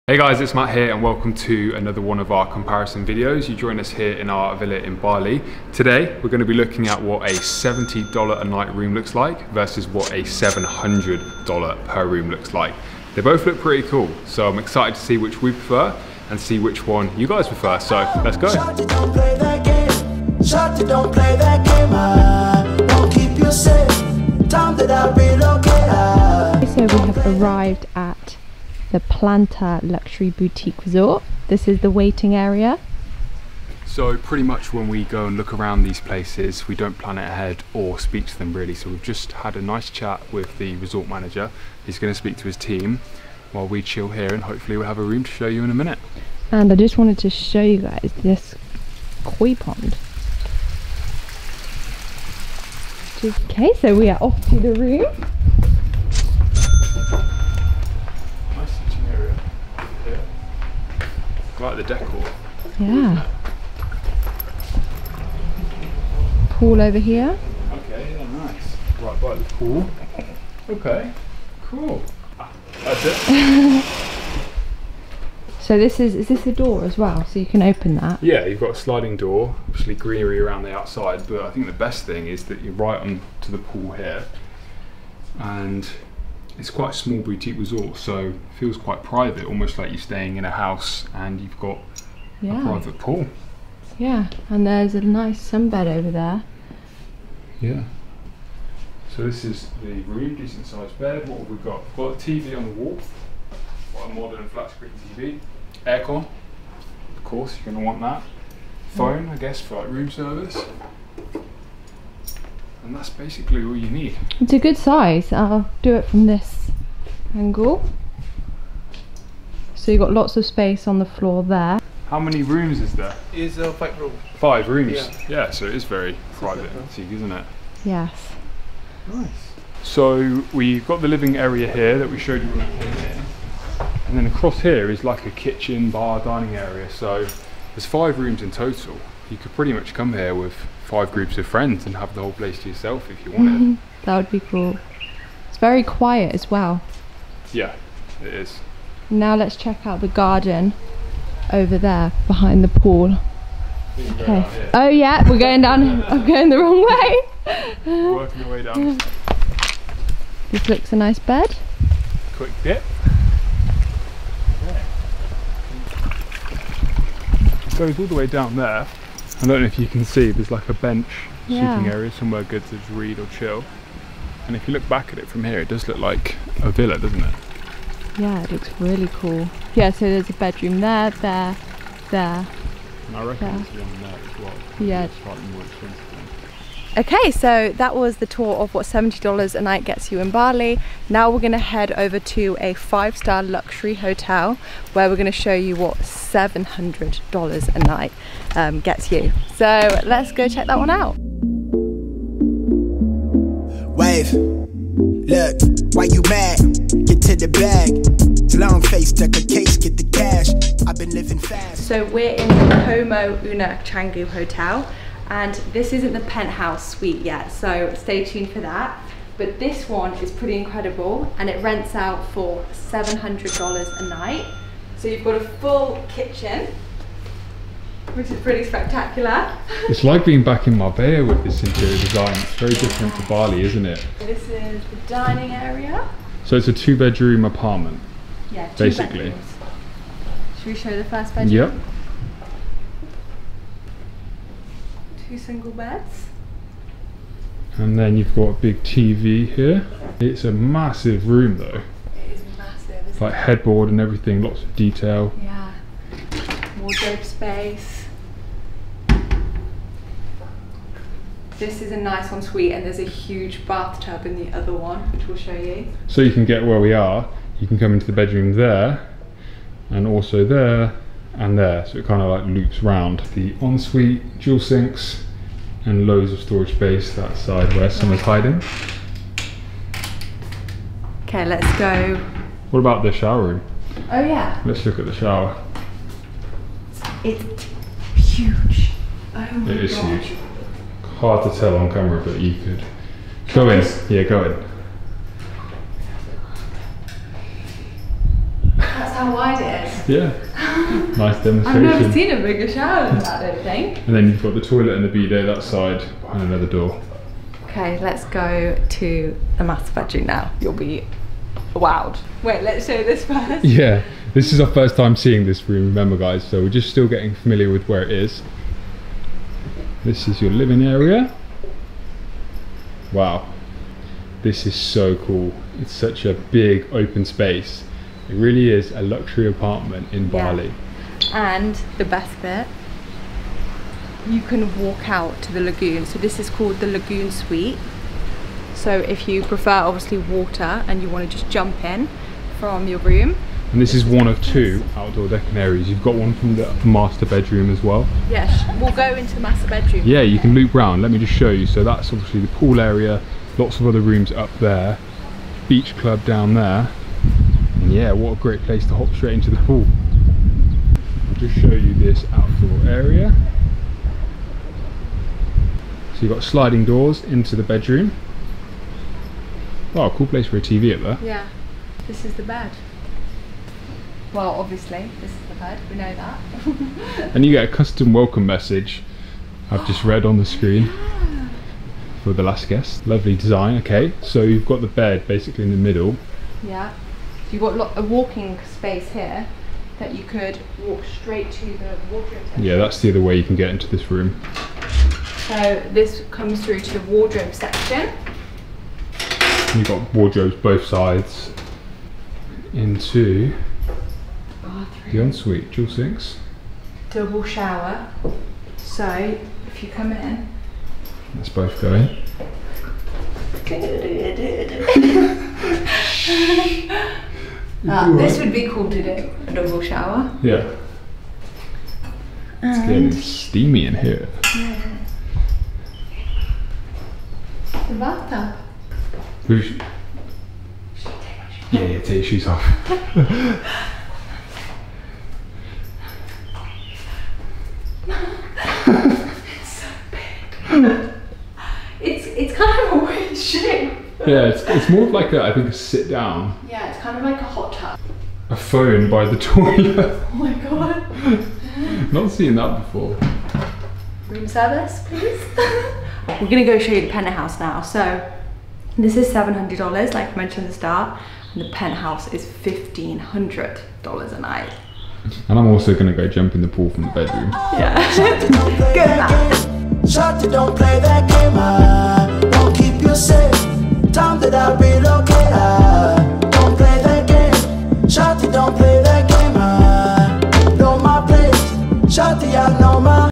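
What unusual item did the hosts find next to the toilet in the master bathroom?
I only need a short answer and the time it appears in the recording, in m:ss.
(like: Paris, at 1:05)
A phone, at 7:28.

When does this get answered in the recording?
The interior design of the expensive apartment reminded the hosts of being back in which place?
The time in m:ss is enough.
3:50.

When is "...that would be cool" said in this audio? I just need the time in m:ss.
2:24.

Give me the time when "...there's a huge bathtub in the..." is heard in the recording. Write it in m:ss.
4:22.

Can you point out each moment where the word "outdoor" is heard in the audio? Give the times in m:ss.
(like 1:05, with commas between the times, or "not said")
5:44, 6:02.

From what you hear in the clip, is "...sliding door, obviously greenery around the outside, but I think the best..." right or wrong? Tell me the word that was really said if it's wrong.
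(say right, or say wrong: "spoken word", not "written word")
right.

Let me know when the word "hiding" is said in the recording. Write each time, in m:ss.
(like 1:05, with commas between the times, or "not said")
4:38.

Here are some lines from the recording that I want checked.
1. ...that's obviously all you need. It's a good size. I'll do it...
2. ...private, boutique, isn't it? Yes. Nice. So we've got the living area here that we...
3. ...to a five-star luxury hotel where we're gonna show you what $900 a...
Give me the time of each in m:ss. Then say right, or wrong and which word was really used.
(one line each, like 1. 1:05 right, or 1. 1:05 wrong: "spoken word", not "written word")
1. 1:52 wrong: "basically", not "obviously"
2. 2:06 right
3. 3:12 wrong: "700", not "900".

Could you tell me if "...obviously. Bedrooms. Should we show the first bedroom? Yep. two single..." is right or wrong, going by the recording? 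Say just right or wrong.
wrong.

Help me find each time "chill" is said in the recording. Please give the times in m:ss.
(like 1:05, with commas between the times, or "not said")
0:43, 2:53.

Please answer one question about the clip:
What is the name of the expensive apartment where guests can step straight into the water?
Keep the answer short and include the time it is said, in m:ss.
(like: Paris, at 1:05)
Lagoon suite, at 5:36.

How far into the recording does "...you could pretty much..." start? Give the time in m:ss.
2:19.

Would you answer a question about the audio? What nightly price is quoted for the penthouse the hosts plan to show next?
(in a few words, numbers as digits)
$1,500.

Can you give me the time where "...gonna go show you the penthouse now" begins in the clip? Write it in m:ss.
7:36.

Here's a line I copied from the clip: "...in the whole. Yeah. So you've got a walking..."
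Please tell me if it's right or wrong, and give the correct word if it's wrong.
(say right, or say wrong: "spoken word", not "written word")
wrong: "middle", not "whole".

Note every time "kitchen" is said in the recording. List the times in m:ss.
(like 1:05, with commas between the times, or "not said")
2:15, 3:46.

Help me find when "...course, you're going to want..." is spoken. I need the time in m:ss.
1:47.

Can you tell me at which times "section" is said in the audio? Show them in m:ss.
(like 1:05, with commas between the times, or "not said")
6:32, 6:37.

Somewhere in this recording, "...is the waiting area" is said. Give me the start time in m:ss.
0:31.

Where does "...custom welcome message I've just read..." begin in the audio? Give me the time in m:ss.
6:17.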